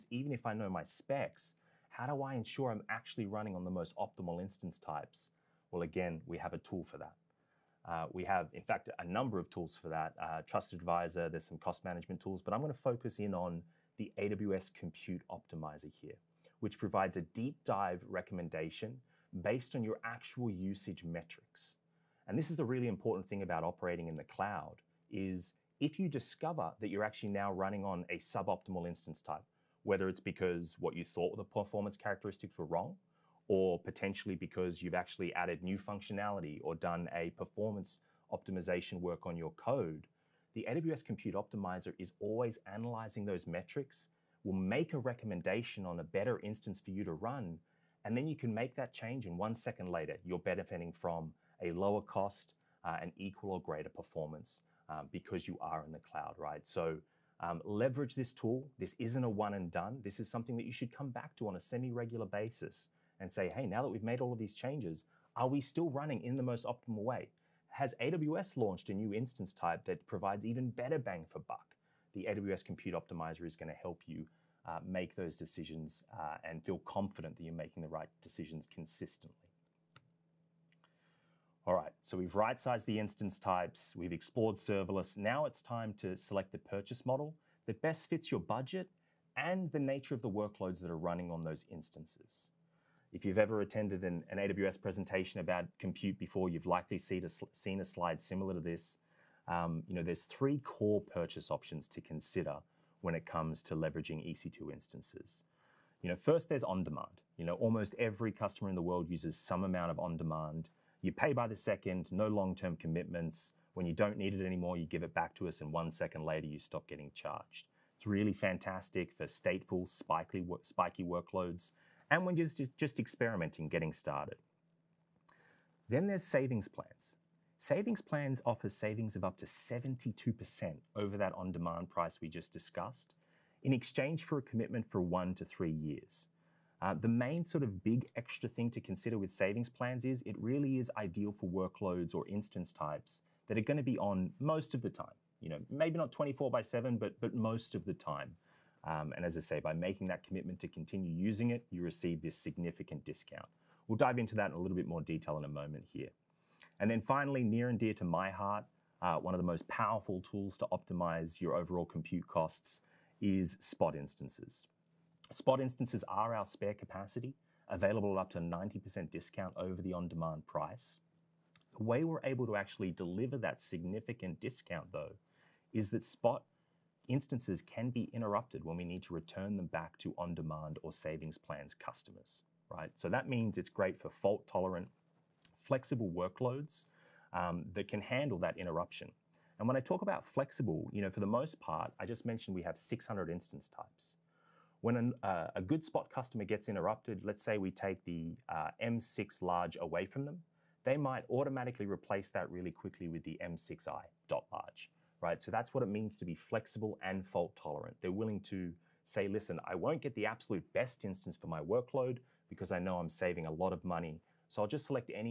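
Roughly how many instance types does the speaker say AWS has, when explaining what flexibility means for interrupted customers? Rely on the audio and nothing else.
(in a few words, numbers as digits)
600.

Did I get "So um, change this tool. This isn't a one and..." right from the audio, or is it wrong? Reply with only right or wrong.
wrong.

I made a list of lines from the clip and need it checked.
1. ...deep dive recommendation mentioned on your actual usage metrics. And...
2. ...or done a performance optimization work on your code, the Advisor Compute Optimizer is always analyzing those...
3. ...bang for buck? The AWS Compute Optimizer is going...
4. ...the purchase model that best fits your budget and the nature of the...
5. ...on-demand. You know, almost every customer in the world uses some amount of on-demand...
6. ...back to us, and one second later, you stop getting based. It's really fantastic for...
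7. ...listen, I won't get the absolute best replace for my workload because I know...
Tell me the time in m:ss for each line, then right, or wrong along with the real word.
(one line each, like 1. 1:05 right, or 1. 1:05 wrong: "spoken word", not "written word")
1. 0:17 wrong: "based", not "mentioned"
2. 0:36 wrong: "AWS", not "Advisor"
3. 1:10 right
4. 1:26 right
5. 1:46 right
6. 1:55 wrong: "charged", not "based"
7. 3:29 wrong: "instance", not "replace".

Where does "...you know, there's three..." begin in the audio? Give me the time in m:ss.
1:39.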